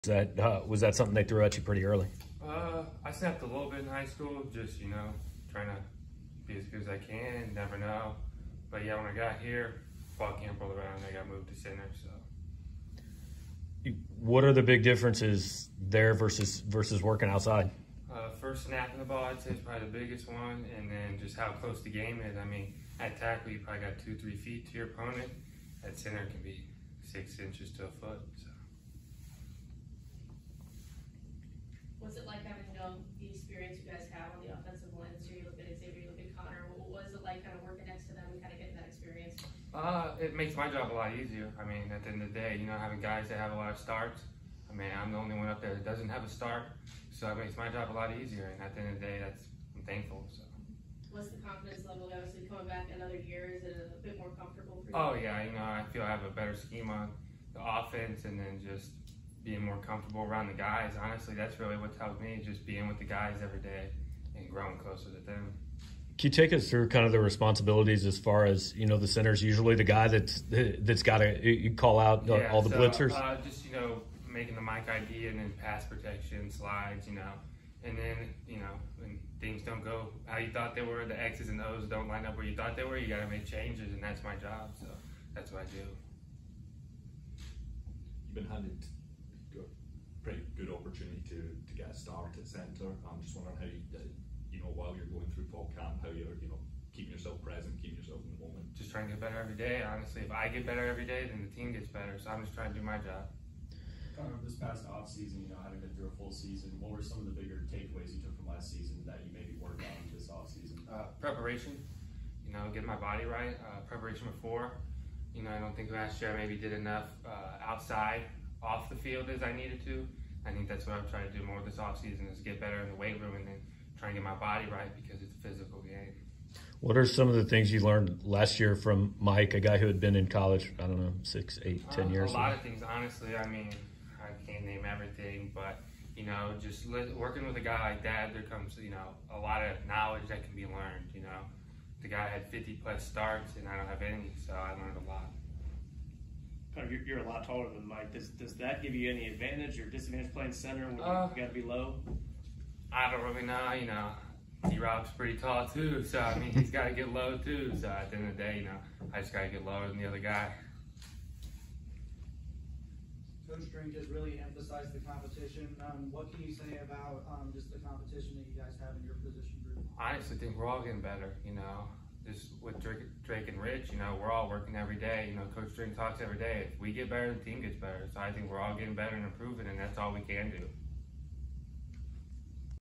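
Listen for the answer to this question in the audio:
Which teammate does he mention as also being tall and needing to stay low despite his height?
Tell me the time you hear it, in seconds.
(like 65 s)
154 s.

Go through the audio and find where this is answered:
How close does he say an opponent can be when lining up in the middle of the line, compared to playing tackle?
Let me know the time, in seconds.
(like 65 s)
27 s.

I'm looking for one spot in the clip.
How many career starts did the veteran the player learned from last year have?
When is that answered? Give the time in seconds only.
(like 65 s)
142 s.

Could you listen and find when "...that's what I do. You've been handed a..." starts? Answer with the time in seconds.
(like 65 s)
85 s.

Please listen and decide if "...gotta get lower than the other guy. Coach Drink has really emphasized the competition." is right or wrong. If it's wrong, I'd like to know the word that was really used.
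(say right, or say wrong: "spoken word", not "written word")
right.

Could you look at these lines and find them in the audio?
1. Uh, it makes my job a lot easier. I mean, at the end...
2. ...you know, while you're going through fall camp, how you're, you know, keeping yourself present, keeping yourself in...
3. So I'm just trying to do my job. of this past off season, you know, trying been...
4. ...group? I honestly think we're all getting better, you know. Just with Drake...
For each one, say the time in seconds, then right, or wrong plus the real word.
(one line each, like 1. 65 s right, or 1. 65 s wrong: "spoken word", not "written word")
1. 39 s right
2. 94 s right
3. 102 s wrong: "having", not "trying"
4. 169 s right.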